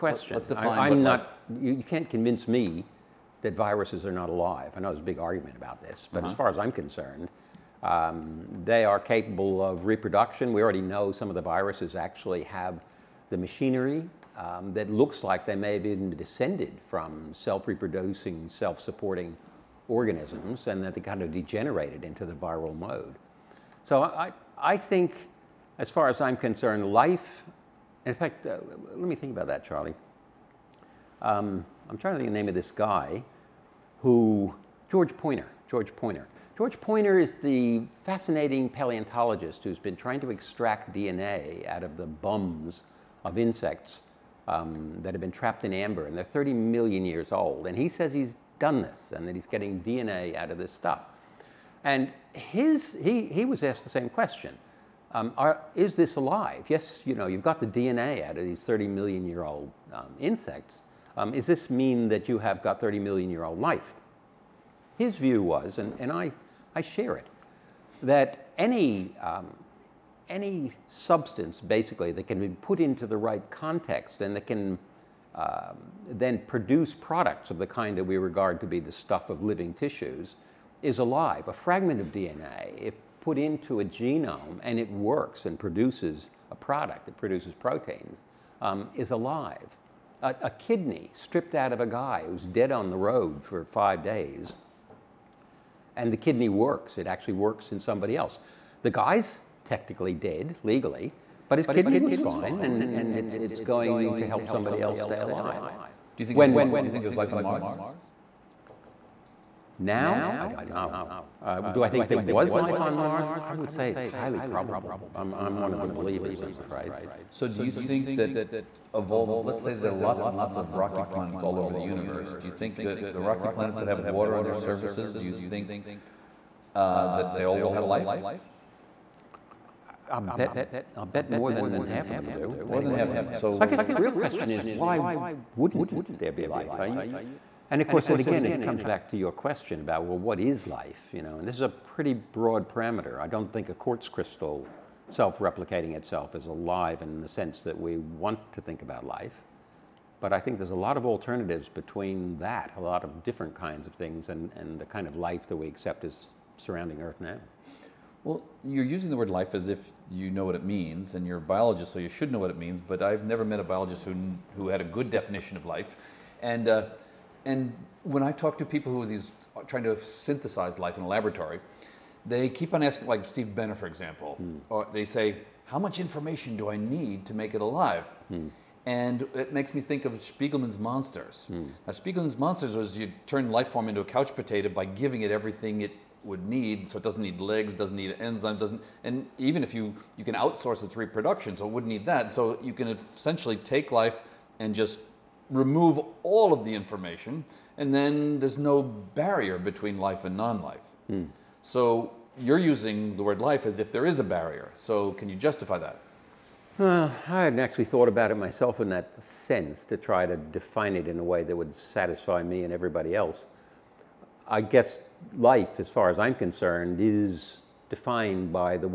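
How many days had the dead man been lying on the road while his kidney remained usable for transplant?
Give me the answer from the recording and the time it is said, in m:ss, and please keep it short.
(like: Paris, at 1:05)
5, at 1:33.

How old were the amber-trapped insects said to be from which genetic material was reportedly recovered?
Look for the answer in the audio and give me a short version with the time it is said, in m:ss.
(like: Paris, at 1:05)
30 million years, at 0:46.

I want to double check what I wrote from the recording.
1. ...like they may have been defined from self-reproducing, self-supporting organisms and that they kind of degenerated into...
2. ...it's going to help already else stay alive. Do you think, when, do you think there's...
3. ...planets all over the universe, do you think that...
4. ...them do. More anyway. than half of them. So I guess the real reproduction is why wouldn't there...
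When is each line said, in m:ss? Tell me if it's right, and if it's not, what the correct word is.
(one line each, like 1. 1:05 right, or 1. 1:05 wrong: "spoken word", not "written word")
1. 0:15 wrong: "descended", not "defined"
2. 1:43 wrong: "somebody", not "already"
3. 2:01 right
4. 2:12 wrong: "question", not "reproduction".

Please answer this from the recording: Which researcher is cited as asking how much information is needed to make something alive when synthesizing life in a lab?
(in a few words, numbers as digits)
Steve Benner.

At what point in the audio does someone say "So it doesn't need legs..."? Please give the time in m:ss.
3:06.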